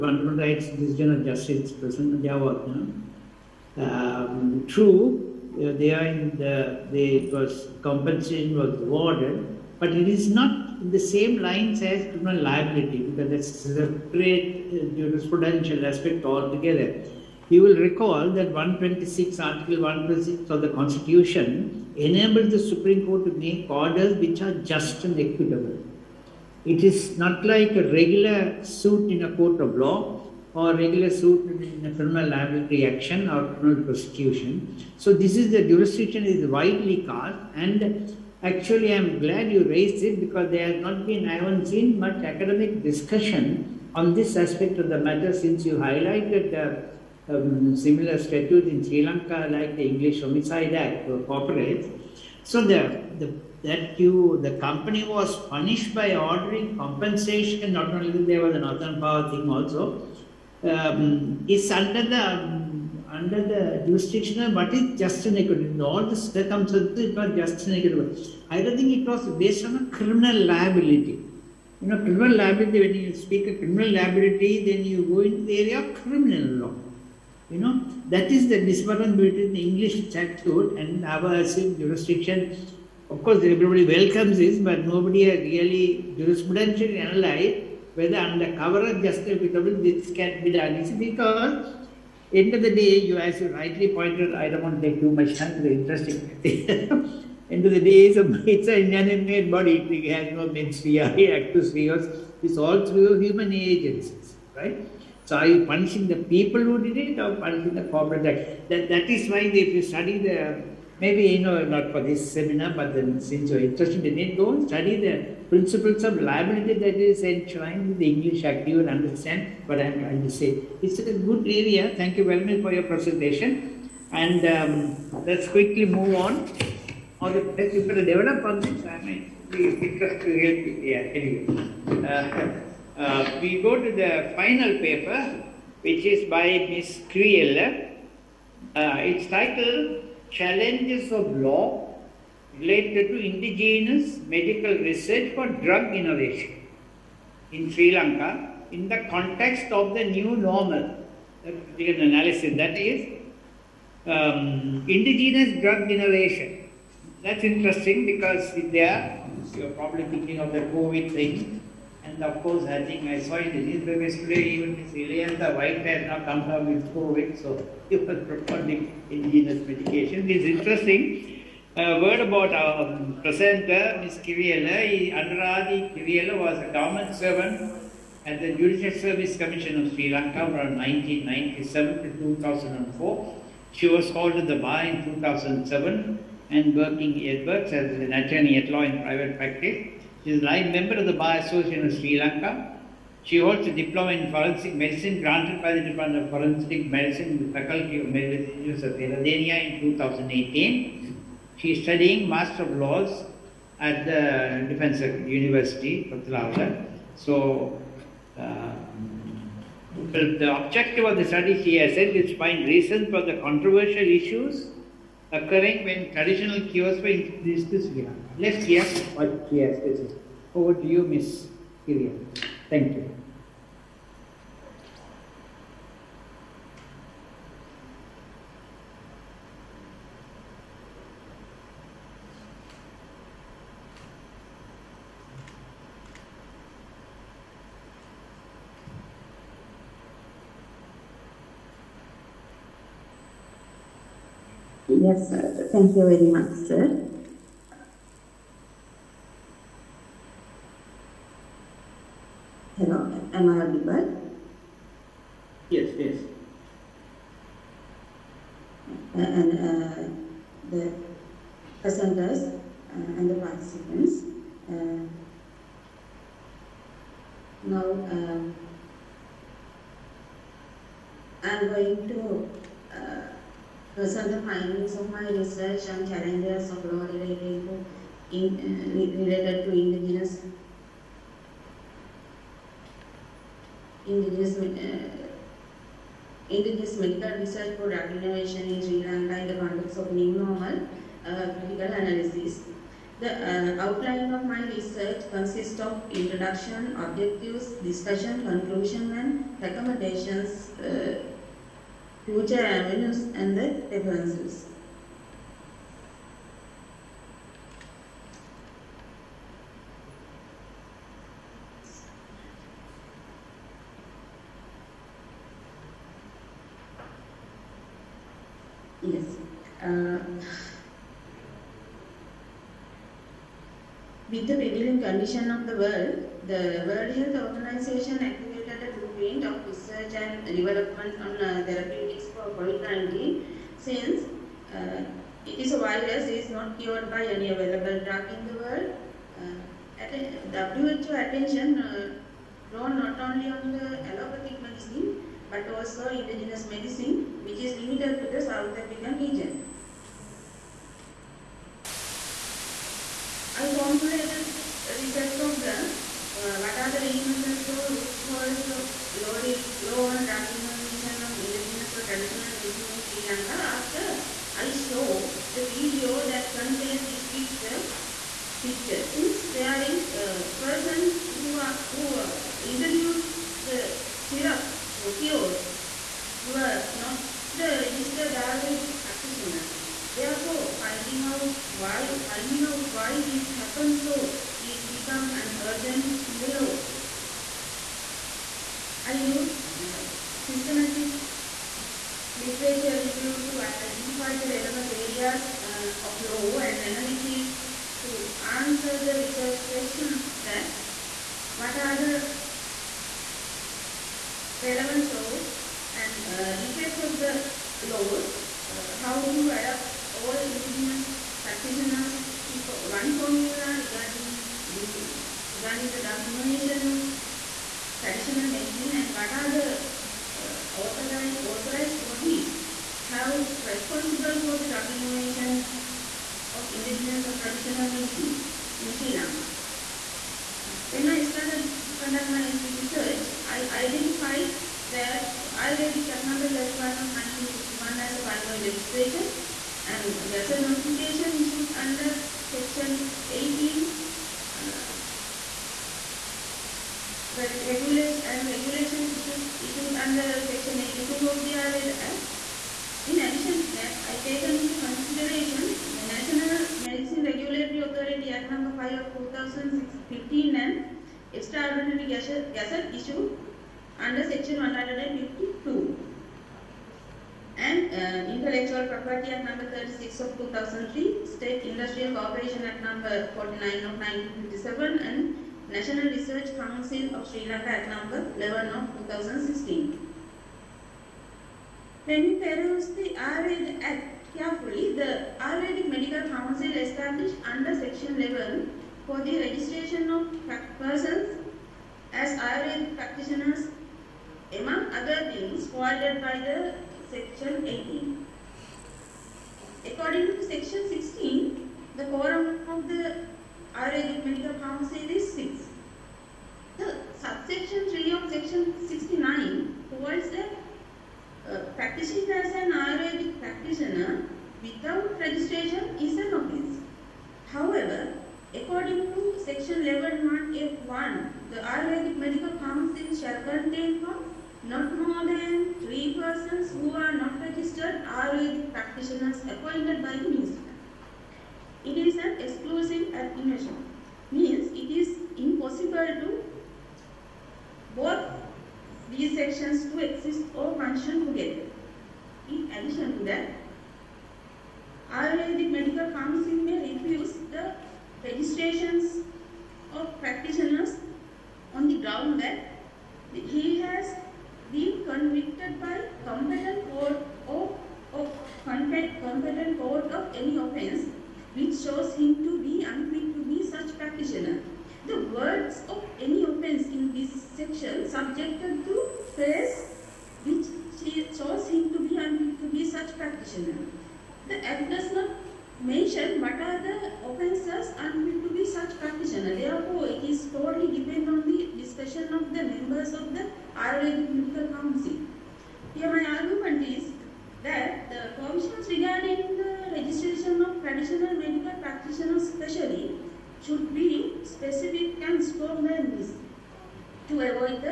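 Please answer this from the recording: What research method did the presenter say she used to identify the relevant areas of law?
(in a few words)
systematic literature review.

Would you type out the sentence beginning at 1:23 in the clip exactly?
Of course, everybody welcomes this, but nobody has really jurisprudentially analyzed whether under cover of justifiable this can be done easily.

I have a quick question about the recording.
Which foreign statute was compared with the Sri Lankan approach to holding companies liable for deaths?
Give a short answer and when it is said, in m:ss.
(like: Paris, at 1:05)
English Homicide Act, at 0:49.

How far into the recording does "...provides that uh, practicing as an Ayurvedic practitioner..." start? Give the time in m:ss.
8:29.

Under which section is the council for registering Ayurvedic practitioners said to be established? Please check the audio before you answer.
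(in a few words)
section 11.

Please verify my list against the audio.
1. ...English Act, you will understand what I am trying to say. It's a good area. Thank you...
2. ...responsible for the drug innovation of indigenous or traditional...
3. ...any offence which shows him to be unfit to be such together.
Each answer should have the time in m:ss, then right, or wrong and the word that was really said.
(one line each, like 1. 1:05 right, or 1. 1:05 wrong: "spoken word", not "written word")
1. 1:58 right
2. 7:03 right
3. 9:20 wrong: "practitioner", not "together".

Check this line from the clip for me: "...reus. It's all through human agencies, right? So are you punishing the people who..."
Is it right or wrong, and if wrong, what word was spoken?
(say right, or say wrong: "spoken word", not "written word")
right.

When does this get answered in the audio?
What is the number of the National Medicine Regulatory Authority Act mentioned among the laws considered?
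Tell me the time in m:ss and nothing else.
7:38.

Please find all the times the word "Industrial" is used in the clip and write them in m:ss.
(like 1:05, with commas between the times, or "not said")
7:51.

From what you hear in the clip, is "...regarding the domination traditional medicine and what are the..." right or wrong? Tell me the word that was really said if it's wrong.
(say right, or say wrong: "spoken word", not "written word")
right.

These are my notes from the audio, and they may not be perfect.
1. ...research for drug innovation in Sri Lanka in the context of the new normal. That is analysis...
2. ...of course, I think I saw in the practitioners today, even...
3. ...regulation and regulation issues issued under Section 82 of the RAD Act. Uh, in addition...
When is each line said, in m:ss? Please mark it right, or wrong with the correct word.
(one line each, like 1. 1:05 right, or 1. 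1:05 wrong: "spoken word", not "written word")
1. 2:24 right
2. 2:42 wrong: "newspapers", not "practitioners"
3. 7:27 right.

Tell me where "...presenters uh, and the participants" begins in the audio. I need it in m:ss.
4:21.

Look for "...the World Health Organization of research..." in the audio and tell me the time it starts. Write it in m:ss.
5:26.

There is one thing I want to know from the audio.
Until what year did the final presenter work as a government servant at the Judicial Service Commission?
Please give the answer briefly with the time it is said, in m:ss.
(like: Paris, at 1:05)
2004, at 3:02.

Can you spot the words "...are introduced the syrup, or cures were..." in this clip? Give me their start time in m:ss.
6:12.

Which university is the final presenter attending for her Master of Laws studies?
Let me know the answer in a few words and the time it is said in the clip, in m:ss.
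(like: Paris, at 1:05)
Defense University, Kotelawala, at 3:24.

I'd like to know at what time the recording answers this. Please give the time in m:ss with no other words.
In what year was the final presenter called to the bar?
3:05.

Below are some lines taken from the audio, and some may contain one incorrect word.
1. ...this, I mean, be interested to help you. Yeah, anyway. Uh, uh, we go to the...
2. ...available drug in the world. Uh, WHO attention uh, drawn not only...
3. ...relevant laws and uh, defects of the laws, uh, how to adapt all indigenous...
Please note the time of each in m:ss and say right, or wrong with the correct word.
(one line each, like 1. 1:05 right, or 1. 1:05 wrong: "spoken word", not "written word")
1. 2:08 right
2. 5:37 right
3. 6:44 right.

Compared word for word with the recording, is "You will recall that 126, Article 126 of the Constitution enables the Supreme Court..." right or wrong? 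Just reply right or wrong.
right.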